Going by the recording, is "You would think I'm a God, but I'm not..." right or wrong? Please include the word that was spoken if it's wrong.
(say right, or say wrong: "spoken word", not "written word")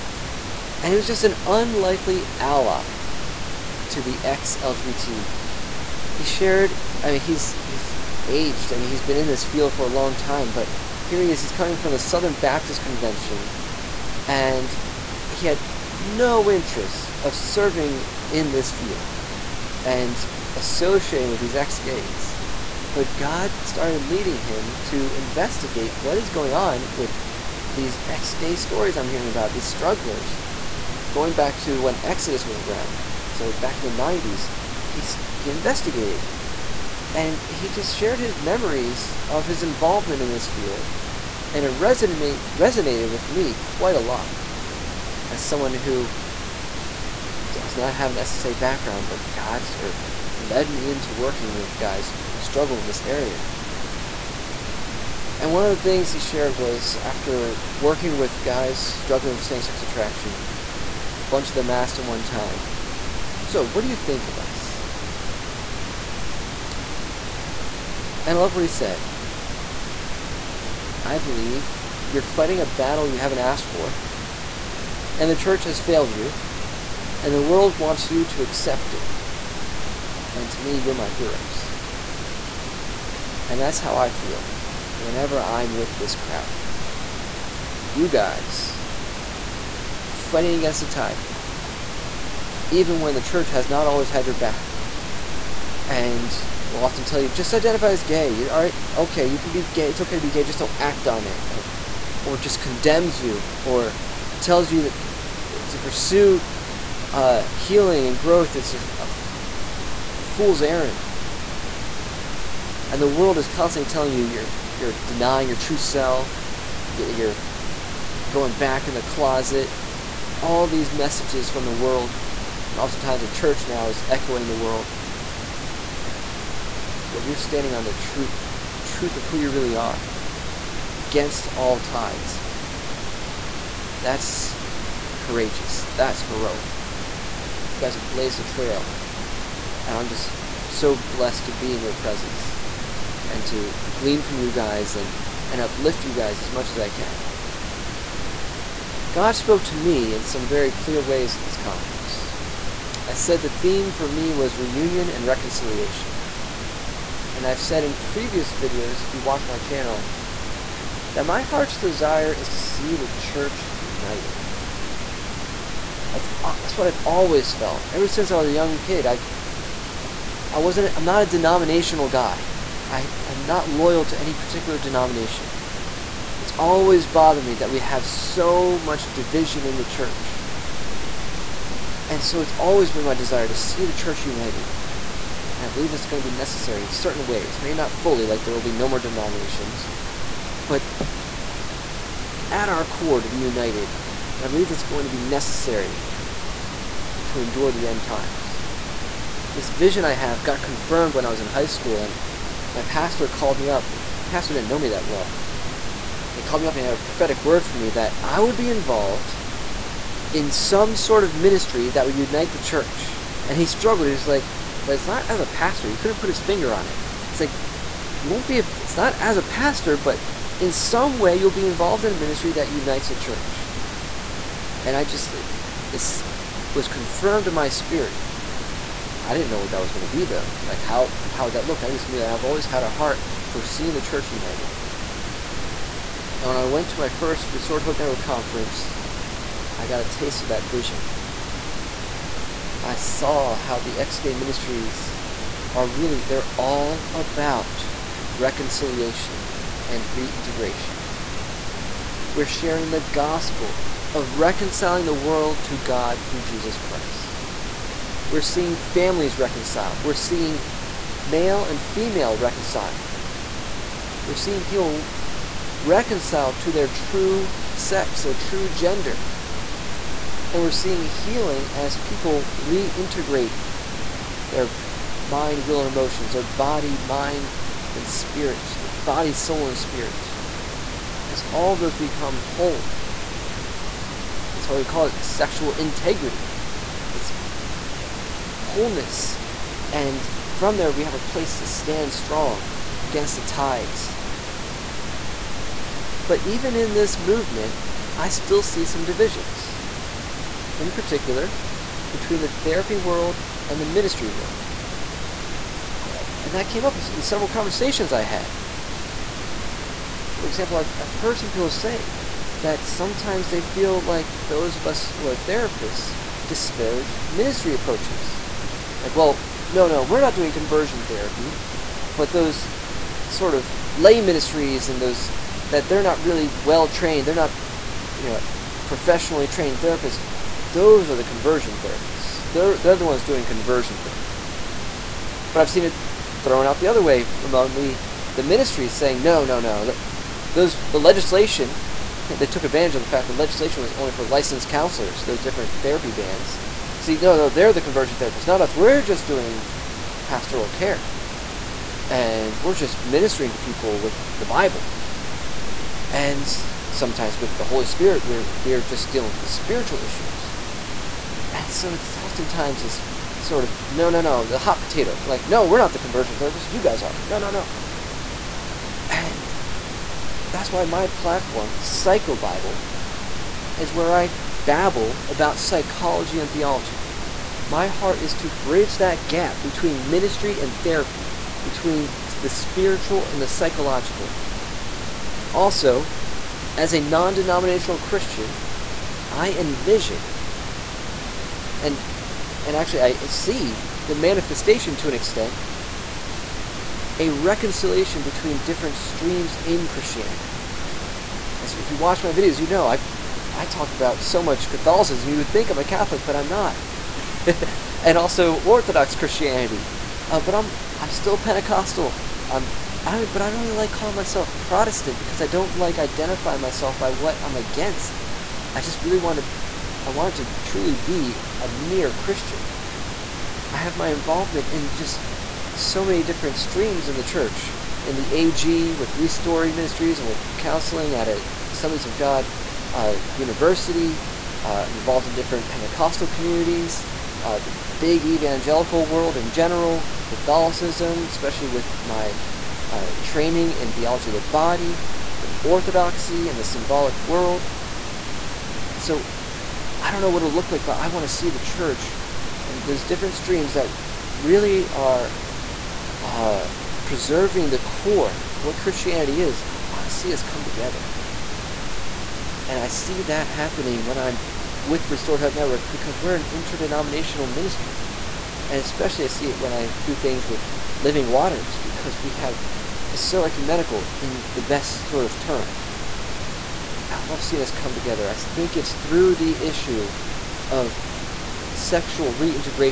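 wrong: "Catholic", not "God".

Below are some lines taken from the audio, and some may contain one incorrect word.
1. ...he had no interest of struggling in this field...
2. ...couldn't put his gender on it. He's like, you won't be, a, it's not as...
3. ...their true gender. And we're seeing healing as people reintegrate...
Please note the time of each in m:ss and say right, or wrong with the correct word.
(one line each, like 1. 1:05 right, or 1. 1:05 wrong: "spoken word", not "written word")
1. 0:15 wrong: "serving", not "struggling"
2. 3:35 wrong: "finger", not "gender"
3. 4:28 right.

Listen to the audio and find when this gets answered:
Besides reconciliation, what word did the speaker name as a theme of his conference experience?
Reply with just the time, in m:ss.
2:34.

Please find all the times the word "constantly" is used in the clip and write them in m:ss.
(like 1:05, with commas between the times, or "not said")
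1:53.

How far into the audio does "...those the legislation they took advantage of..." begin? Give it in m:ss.
5:40.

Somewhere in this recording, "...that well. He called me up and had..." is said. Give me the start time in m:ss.
3:24.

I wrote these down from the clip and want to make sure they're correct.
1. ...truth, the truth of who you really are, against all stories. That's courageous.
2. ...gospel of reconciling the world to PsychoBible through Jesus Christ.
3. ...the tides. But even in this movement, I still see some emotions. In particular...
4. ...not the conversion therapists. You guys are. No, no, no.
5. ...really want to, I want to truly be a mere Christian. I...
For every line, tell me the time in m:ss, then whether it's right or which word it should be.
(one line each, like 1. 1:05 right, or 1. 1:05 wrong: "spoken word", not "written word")
1. 2:07 wrong: "tides", not "stories"
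2. 4:13 wrong: "God", not "PsychoBible"
3. 4:53 wrong: "divisions", not "emotions"
4. 6:05 right
5. 6:59 right.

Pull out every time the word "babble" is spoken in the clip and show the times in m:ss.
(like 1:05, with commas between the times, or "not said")
6:14.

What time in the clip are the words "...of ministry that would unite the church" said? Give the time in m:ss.
3:31.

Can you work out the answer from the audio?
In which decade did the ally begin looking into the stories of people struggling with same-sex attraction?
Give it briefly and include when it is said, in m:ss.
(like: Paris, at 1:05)
the 90s, at 0:33.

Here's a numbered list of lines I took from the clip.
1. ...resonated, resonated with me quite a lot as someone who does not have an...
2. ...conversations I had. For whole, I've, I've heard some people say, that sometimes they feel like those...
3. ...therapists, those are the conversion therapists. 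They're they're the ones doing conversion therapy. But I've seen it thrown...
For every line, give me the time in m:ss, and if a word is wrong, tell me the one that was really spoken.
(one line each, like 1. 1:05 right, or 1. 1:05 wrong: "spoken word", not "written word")
1. 0:41 right
2. 5:07 wrong: "example", not "whole"
3. 5:29 right.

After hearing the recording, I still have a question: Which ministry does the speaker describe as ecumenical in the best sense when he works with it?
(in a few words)
Living Waters.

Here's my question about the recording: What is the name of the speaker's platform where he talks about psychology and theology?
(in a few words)
PsychoBible.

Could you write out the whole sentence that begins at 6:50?
Uh, but I'm I'm still Pentecostal.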